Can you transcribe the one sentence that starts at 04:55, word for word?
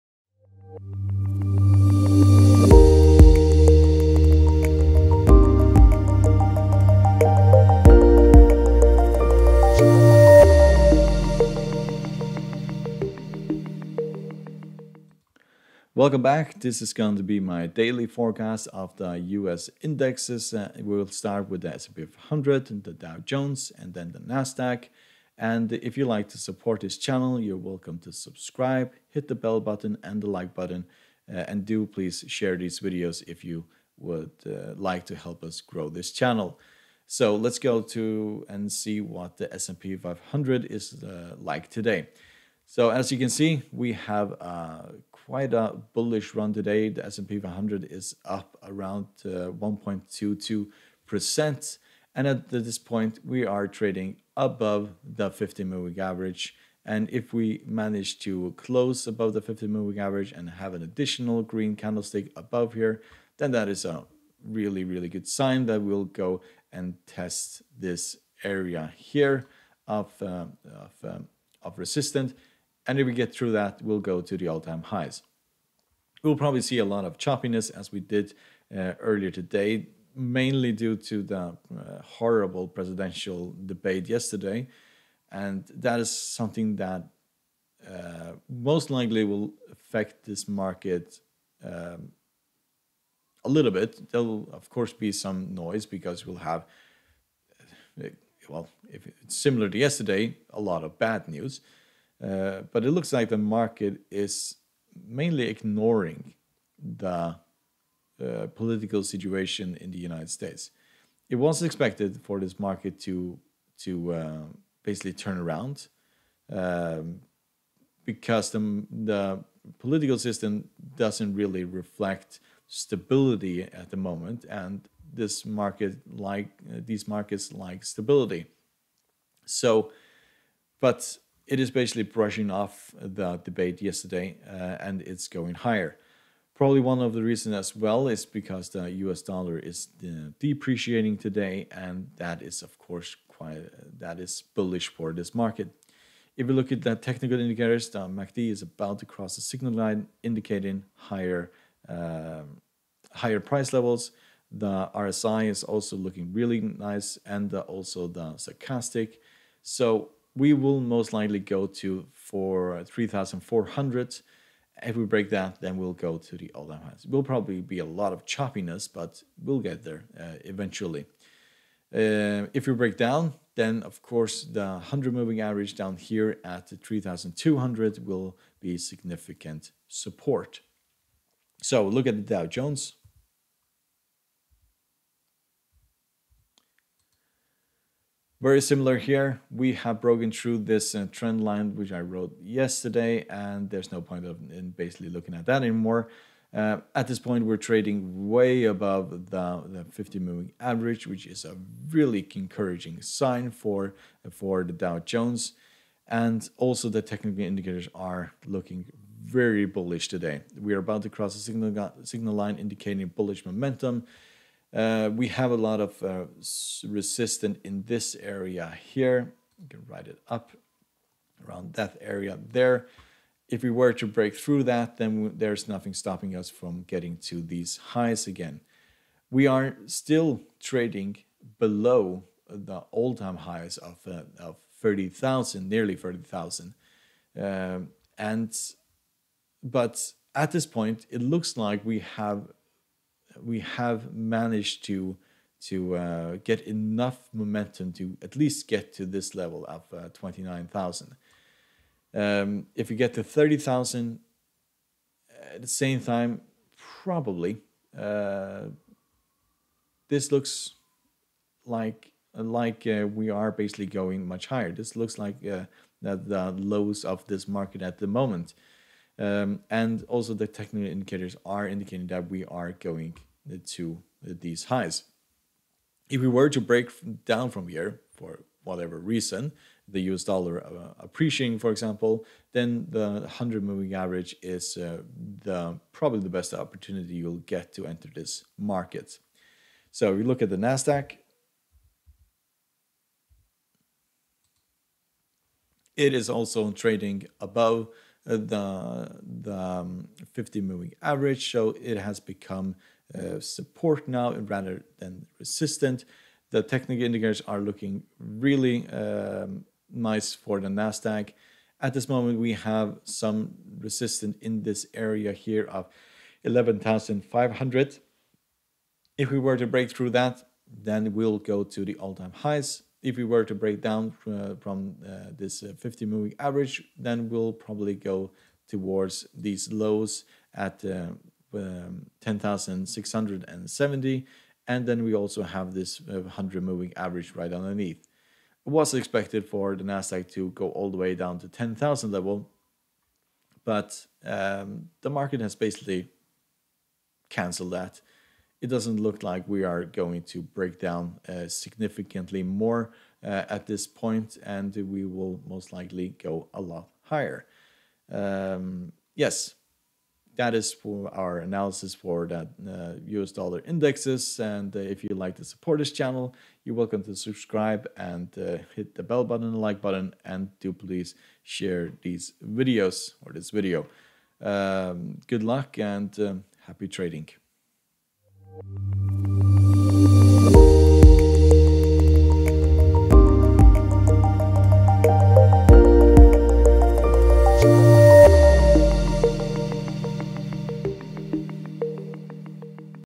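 It is also trading above uh, the, the um, 50 moving average.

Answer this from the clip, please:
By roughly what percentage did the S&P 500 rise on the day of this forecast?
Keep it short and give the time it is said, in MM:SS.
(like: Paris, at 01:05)
1.22%, at 00:49.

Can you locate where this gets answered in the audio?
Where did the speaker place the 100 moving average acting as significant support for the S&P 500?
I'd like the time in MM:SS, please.
02:56.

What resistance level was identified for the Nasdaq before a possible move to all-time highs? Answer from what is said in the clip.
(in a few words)
11,500.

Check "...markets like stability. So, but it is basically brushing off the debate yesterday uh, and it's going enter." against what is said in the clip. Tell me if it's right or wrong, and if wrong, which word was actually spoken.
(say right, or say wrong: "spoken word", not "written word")
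wrong: "higher", not "enter".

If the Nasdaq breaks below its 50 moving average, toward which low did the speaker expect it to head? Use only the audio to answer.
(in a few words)
10,670.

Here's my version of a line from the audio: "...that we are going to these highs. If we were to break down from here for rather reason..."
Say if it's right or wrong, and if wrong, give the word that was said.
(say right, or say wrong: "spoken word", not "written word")
wrong: "whatever", not "rather".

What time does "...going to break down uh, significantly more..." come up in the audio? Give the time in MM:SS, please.
05:49.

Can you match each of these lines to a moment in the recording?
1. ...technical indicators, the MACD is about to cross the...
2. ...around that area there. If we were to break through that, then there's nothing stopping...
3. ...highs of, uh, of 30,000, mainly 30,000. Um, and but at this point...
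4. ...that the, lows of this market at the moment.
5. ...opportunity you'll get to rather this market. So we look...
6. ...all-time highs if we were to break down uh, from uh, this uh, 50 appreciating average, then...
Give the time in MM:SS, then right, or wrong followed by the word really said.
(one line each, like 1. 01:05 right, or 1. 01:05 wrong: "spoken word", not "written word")
1. 02:26 right
2. 03:41 right
3. 03:53 wrong: "nearly", not "mainly"
4. 04:26 right
5. 04:46 wrong: "enter", not "rather"
6. 05:21 wrong: "moving", not "appreciating".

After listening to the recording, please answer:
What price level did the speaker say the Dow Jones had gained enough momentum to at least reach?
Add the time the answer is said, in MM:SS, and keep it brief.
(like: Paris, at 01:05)
29,000, at 04:10.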